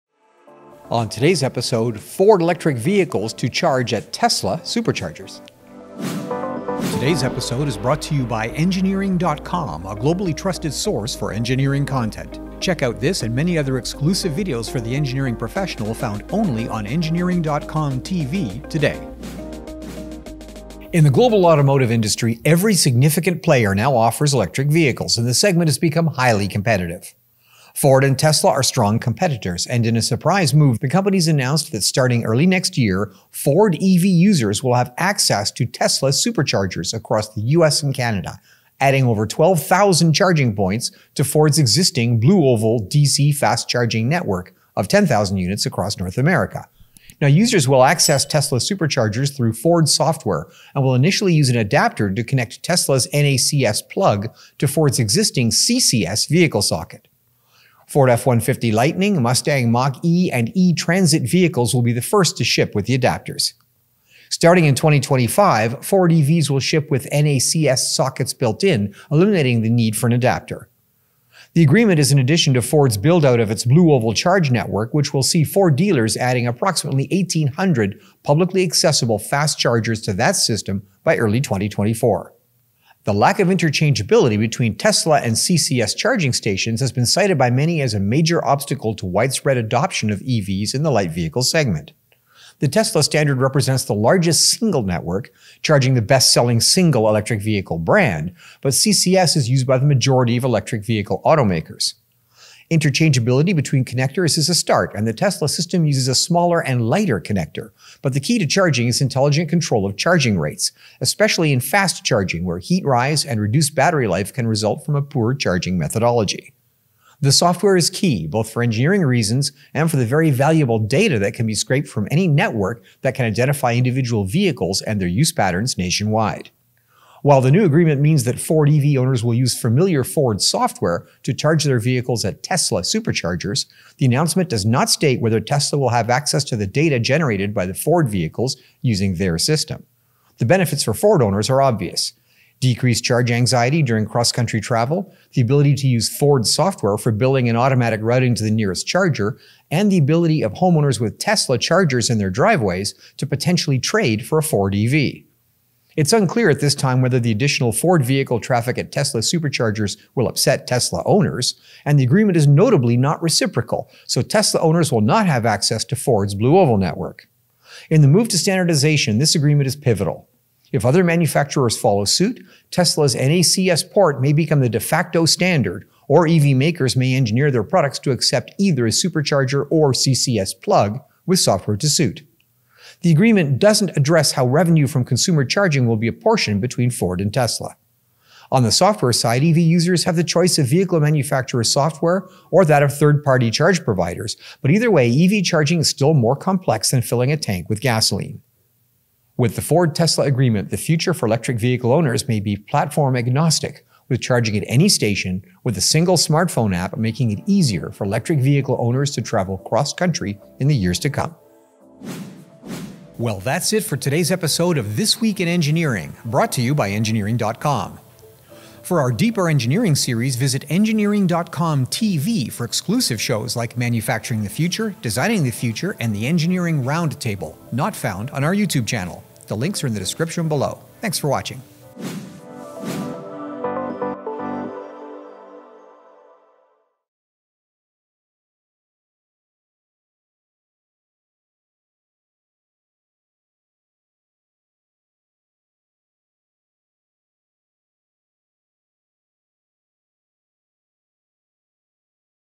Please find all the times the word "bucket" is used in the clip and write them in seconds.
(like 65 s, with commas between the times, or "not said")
not said.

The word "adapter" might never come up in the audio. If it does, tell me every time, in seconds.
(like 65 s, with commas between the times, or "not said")
51 s, 62 s, 70 s.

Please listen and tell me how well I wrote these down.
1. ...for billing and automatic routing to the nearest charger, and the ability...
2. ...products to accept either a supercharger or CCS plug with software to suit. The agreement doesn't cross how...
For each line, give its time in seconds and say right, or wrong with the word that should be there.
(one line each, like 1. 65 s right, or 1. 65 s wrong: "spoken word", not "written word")
1. 146 s right
2. 177 s wrong: "address", not "cross".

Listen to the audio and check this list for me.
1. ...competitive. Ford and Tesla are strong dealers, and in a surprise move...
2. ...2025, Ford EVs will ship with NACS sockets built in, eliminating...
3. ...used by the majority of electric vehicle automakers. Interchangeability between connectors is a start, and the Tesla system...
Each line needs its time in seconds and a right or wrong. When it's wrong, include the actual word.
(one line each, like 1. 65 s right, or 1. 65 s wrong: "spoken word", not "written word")
1. 26 s wrong: "competitors", not "dealers"
2. 64 s right
3. 99 s right.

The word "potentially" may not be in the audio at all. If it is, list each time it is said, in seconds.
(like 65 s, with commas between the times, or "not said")
153 s.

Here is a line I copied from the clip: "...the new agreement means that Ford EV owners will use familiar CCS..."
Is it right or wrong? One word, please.
wrong.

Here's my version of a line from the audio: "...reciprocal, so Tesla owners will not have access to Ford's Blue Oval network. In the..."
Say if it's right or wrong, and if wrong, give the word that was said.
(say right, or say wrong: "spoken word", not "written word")
right.